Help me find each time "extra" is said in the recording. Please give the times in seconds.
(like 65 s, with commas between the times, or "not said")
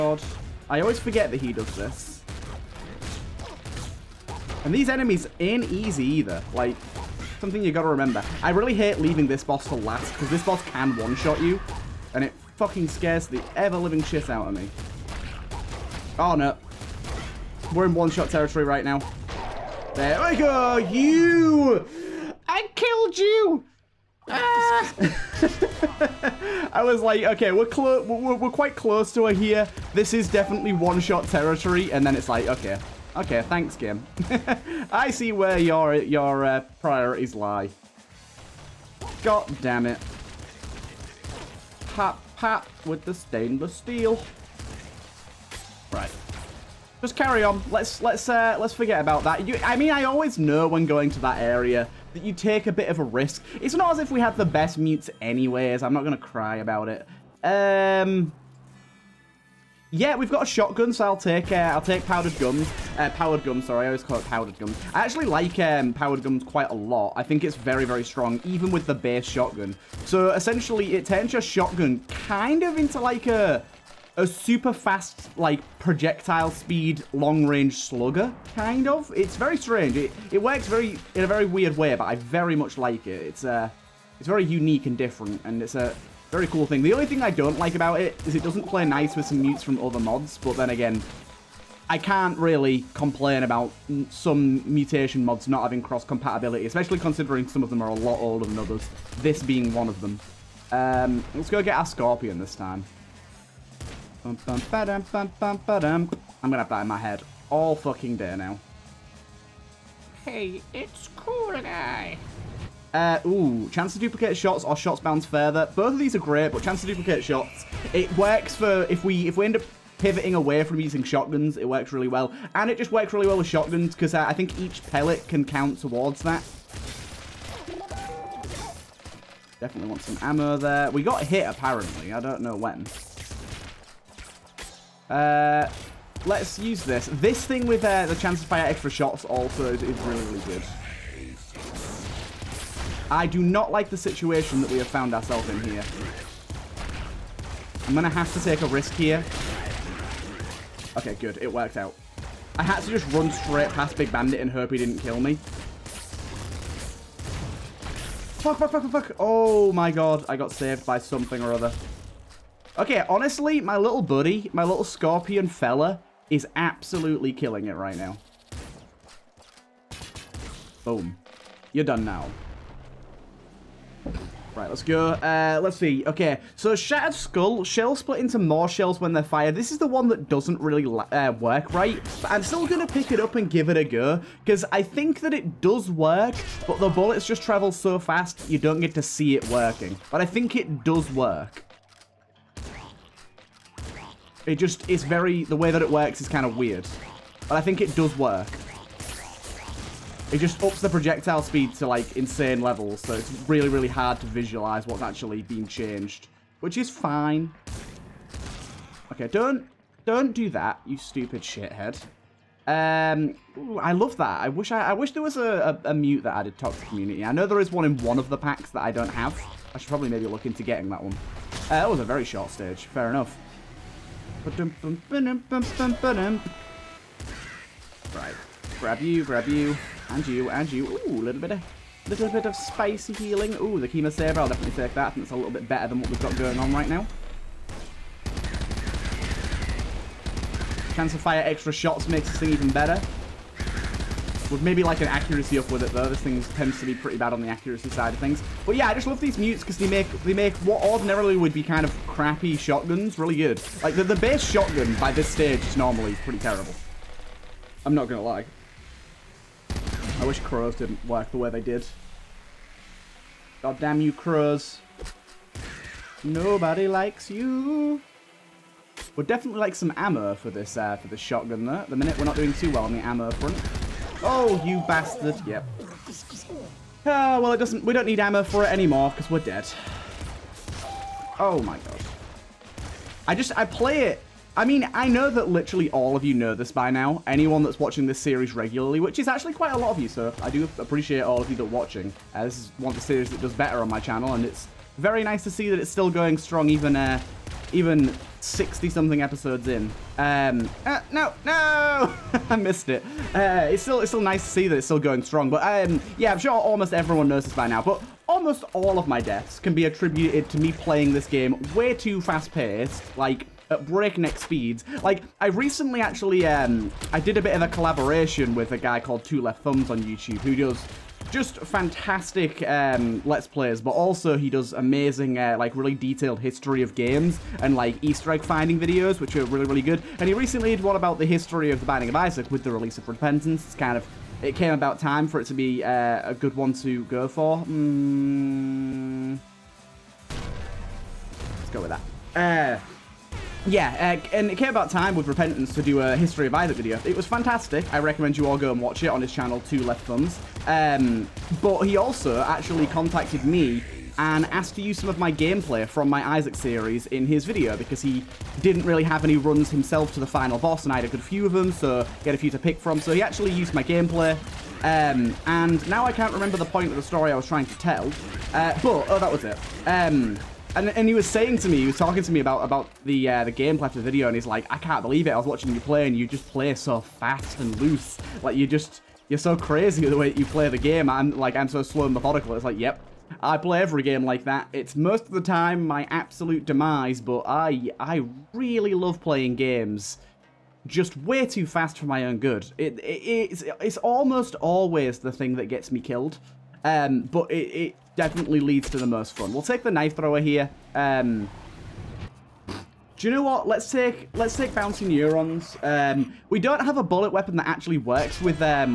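138 s, 241 s.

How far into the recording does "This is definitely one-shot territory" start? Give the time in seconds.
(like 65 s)
29 s.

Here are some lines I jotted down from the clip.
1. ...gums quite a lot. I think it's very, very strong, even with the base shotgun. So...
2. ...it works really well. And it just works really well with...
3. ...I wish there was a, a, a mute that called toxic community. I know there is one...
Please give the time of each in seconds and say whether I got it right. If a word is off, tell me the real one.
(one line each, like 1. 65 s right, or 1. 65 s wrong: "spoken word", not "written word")
1. 66 s right
2. 121 s right
3. 214 s wrong: "added", not "called".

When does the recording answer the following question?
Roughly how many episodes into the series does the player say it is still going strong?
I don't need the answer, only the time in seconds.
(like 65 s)
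298 s.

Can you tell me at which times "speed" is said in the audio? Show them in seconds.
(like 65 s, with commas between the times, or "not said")
76 s, 201 s, 314 s.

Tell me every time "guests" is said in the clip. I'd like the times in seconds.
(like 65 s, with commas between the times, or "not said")
not said.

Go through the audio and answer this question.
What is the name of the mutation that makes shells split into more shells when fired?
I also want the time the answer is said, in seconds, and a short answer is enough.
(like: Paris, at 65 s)
Shattered Skull, at 176 s.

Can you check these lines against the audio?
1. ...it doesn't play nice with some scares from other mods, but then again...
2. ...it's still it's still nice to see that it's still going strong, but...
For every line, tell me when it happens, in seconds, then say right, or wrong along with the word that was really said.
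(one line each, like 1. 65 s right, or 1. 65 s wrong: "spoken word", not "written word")
1. 88 s wrong: "mutes", not "scares"
2. 303 s right.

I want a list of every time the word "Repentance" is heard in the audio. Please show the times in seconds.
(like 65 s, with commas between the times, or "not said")
333 s, 345 s.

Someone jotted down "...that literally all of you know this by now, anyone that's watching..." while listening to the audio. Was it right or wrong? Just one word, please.
right.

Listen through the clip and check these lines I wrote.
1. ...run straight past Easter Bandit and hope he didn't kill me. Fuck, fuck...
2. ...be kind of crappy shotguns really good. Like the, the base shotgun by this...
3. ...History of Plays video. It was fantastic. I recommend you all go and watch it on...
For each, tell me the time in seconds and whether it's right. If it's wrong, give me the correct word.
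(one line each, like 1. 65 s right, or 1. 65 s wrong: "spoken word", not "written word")
1. 153 s wrong: "Big", not "Easter"
2. 251 s right
3. 346 s wrong: "Isaac", not "Plays".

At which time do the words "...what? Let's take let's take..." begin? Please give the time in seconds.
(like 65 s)
403 s.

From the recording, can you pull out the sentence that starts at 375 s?
I was watching you play, and you just play so fast and loose.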